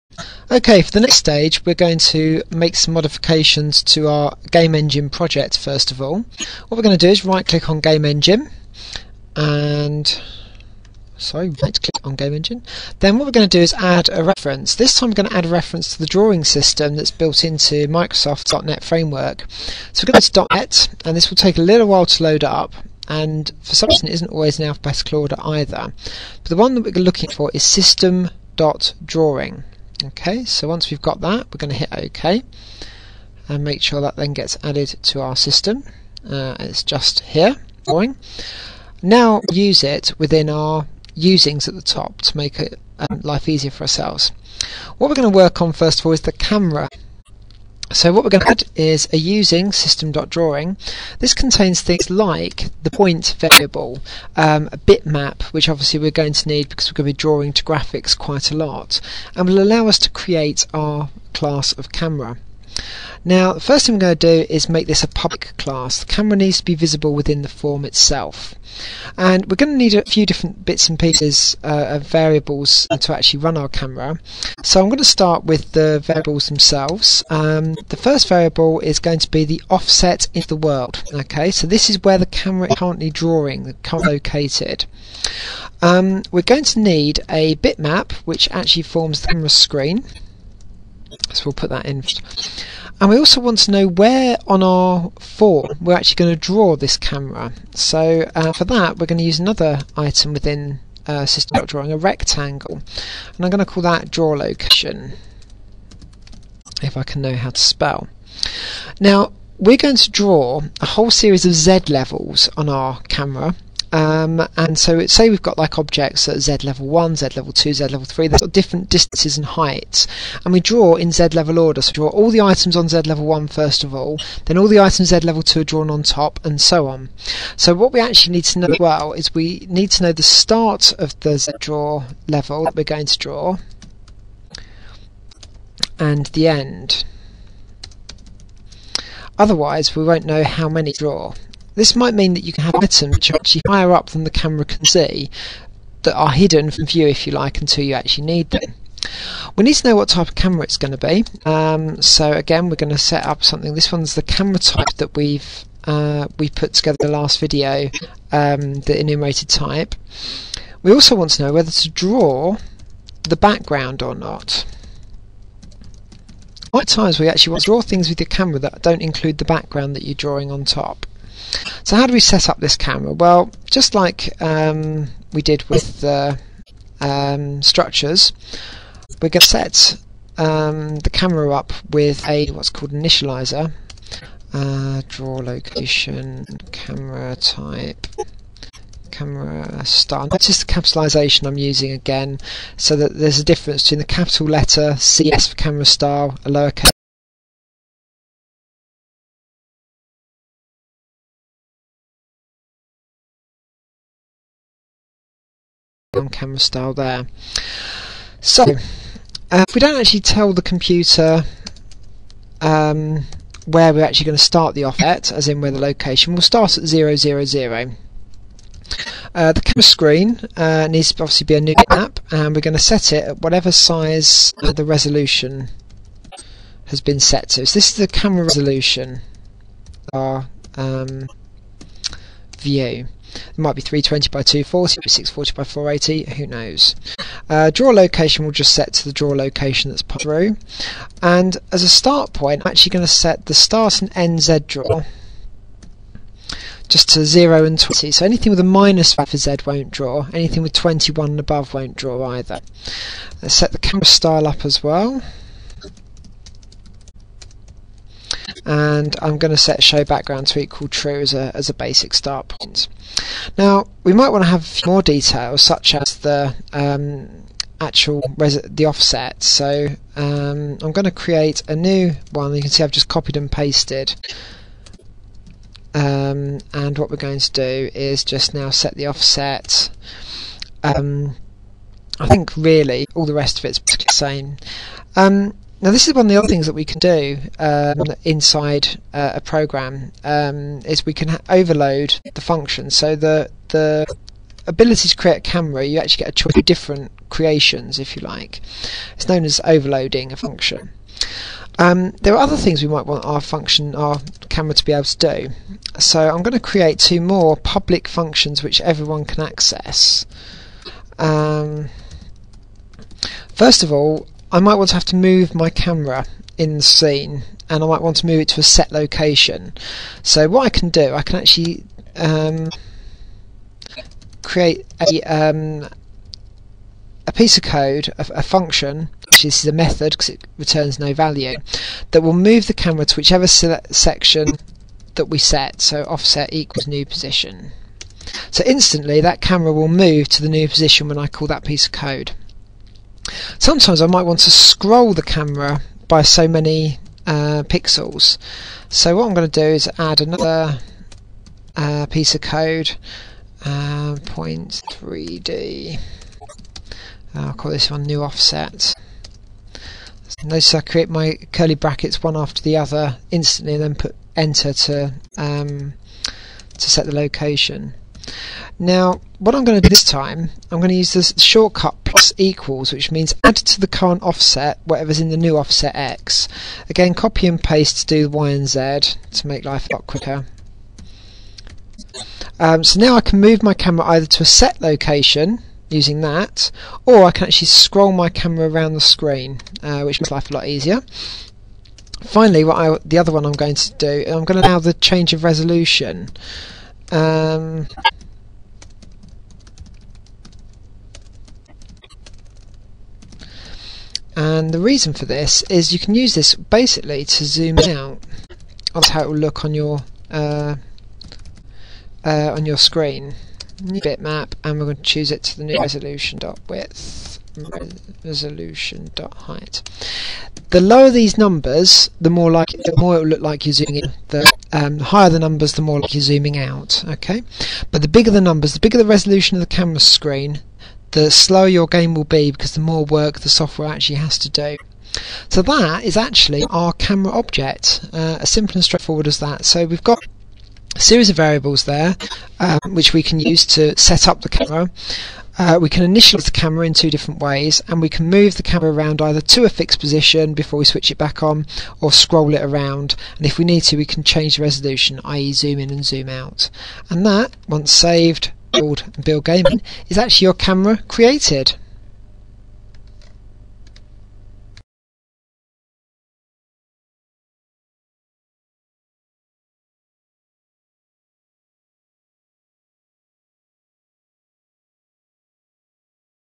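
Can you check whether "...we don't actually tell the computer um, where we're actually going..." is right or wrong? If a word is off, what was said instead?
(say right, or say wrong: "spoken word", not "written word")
right.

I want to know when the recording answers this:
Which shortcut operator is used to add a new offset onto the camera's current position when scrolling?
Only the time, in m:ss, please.
6:12.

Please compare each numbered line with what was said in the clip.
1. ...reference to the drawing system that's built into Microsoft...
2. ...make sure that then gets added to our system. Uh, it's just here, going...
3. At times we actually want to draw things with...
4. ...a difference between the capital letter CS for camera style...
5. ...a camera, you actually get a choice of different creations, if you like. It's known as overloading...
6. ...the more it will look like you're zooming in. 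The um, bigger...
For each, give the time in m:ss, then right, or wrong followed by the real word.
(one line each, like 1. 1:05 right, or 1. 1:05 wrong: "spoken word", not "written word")
1. 0:15 right
2. 0:33 right
3. 2:46 right
4. 3:13 right
5. 4:55 right
6. 7:02 wrong: "higher", not "bigger".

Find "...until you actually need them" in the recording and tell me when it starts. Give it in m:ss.
2:27.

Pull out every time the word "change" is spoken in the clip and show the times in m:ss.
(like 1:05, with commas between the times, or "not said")
6:34, 7:34.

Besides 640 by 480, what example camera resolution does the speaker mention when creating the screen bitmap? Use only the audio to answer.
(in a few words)
320 by 240.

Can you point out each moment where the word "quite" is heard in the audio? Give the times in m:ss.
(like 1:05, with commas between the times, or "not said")
0:58.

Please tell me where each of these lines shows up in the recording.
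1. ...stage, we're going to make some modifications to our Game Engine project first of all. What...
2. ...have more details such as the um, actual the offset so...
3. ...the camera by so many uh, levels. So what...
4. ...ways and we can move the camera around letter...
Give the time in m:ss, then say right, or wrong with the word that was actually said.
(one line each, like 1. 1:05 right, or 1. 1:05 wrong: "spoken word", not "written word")
1. 0:01 right
2. 4:24 right
3. 5:45 wrong: "pixels", not "levels"
4. 7:27 wrong: "either", not "letter".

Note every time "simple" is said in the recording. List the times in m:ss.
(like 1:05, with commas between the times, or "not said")
7:18.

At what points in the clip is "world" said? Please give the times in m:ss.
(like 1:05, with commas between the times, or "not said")
1:20.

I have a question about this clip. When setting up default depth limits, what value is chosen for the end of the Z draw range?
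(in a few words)
20.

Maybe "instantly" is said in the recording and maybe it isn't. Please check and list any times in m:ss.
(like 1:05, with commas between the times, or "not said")
5:38, 6:03.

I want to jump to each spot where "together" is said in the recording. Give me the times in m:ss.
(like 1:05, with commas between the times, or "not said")
2:36.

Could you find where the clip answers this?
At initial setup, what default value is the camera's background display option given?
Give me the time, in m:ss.
4:19.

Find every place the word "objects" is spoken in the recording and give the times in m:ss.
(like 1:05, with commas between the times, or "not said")
1:55, 7:17.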